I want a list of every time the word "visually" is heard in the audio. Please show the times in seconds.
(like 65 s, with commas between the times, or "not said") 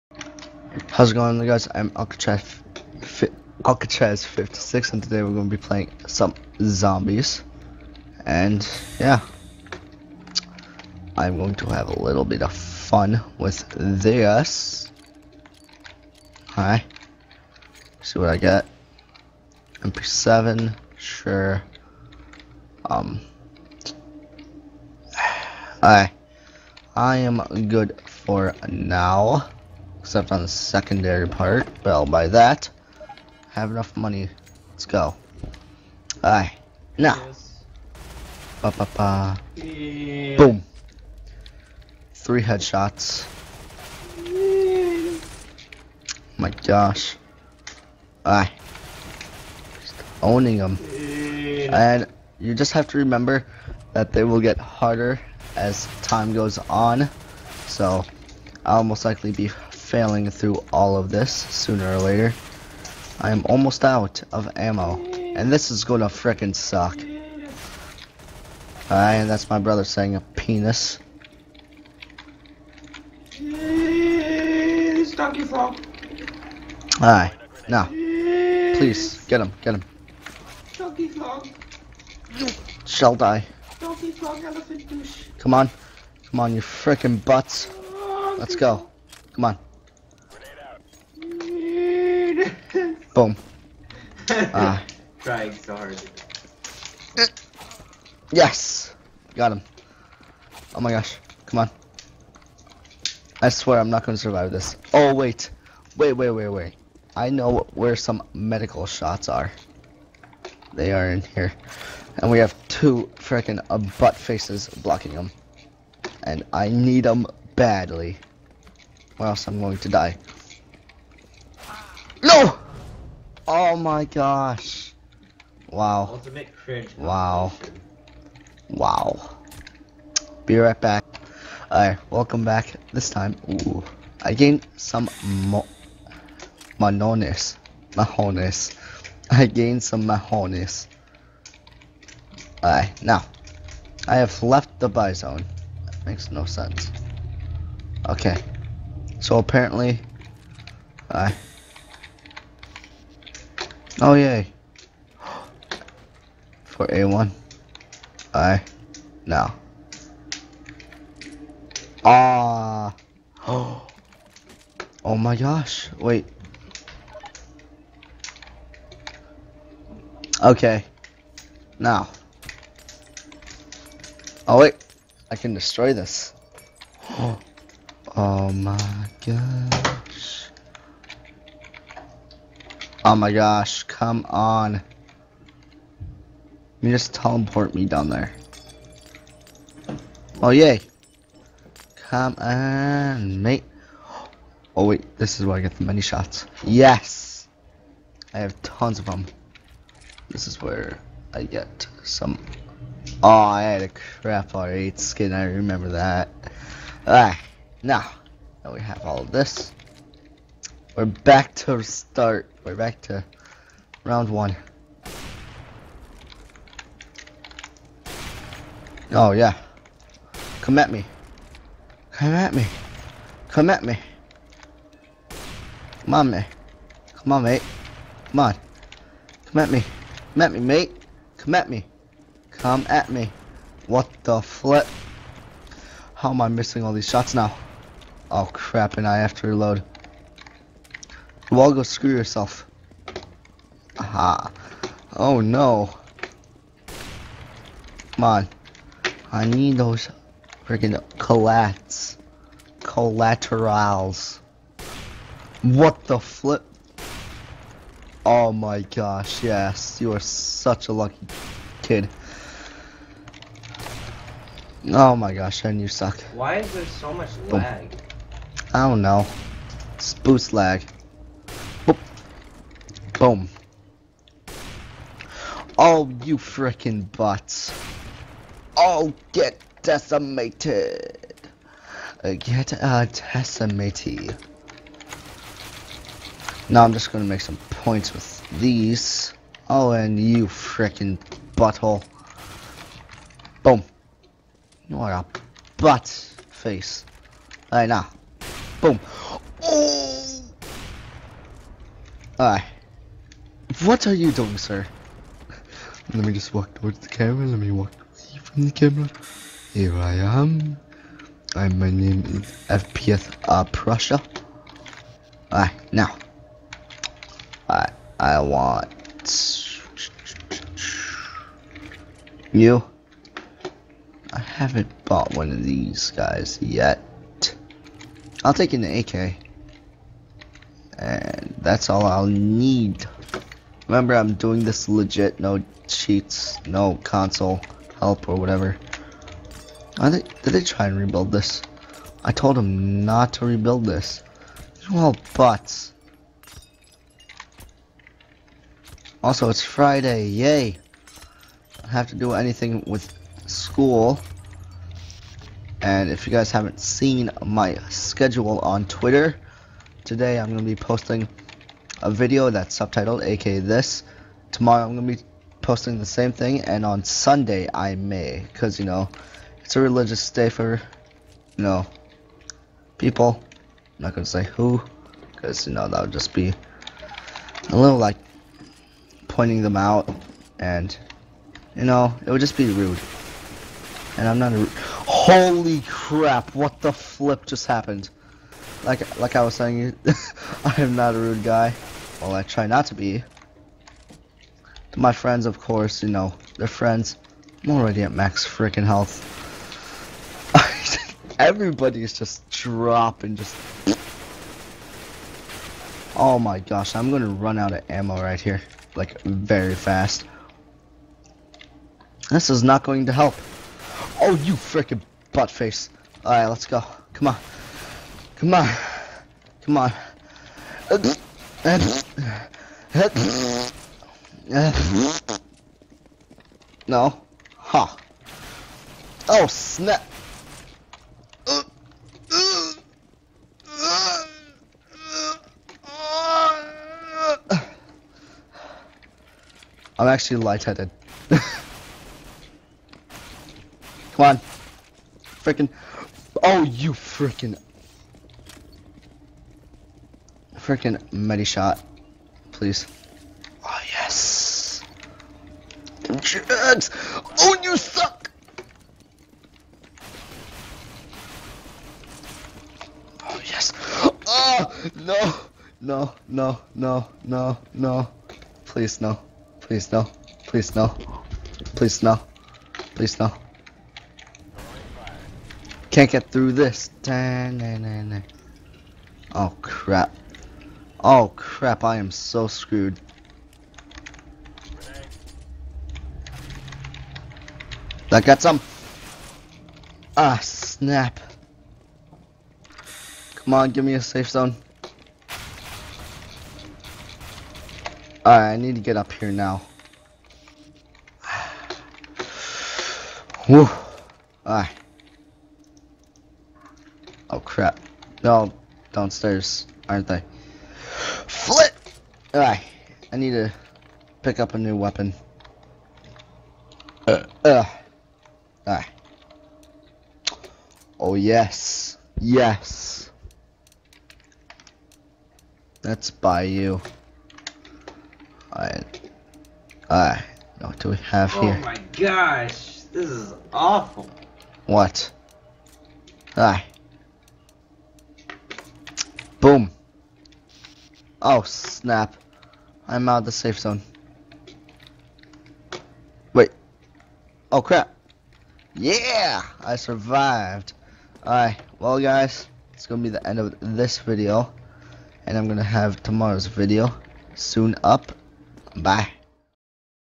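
not said.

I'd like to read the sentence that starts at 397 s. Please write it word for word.
I'm already at max freaking health.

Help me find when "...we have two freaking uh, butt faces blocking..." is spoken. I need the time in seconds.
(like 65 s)
112 s.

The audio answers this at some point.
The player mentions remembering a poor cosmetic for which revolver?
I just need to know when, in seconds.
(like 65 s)
204 s.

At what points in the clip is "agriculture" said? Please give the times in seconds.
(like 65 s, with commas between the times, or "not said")
not said.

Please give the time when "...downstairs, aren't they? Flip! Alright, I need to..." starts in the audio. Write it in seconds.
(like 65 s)
508 s.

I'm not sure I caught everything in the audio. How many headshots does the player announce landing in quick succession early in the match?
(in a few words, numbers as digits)
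3.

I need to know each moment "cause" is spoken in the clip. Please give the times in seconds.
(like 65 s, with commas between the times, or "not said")
368 s, 375 s.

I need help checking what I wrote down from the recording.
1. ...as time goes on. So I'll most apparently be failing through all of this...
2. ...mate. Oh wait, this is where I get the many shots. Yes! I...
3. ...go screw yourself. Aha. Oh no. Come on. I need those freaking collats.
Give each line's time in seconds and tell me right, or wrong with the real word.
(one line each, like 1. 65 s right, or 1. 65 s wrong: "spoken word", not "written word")
1. 55 s wrong: "likely", not "apparently"
2. 193 s right
3. 241 s right.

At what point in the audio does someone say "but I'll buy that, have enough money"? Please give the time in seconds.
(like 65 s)
31 s.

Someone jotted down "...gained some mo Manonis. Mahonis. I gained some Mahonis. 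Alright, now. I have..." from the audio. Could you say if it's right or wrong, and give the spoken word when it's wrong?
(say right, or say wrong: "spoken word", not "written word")
right.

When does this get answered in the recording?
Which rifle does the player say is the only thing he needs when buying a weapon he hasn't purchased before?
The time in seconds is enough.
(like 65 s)
328 s.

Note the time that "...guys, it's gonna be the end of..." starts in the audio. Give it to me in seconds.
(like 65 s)
551 s.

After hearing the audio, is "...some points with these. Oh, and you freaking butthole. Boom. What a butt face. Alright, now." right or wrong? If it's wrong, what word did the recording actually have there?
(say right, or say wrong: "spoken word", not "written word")
right.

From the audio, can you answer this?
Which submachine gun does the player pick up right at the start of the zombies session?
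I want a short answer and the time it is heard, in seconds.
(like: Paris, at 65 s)
MP7, at 19 s.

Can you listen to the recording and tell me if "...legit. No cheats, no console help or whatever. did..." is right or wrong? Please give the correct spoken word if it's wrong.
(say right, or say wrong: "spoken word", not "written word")
right.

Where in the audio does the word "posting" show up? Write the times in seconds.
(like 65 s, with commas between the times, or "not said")
360 s, 365 s.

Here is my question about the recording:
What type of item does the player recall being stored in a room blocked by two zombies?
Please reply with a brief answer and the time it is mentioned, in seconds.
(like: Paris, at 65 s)
medical shots, at 108 s.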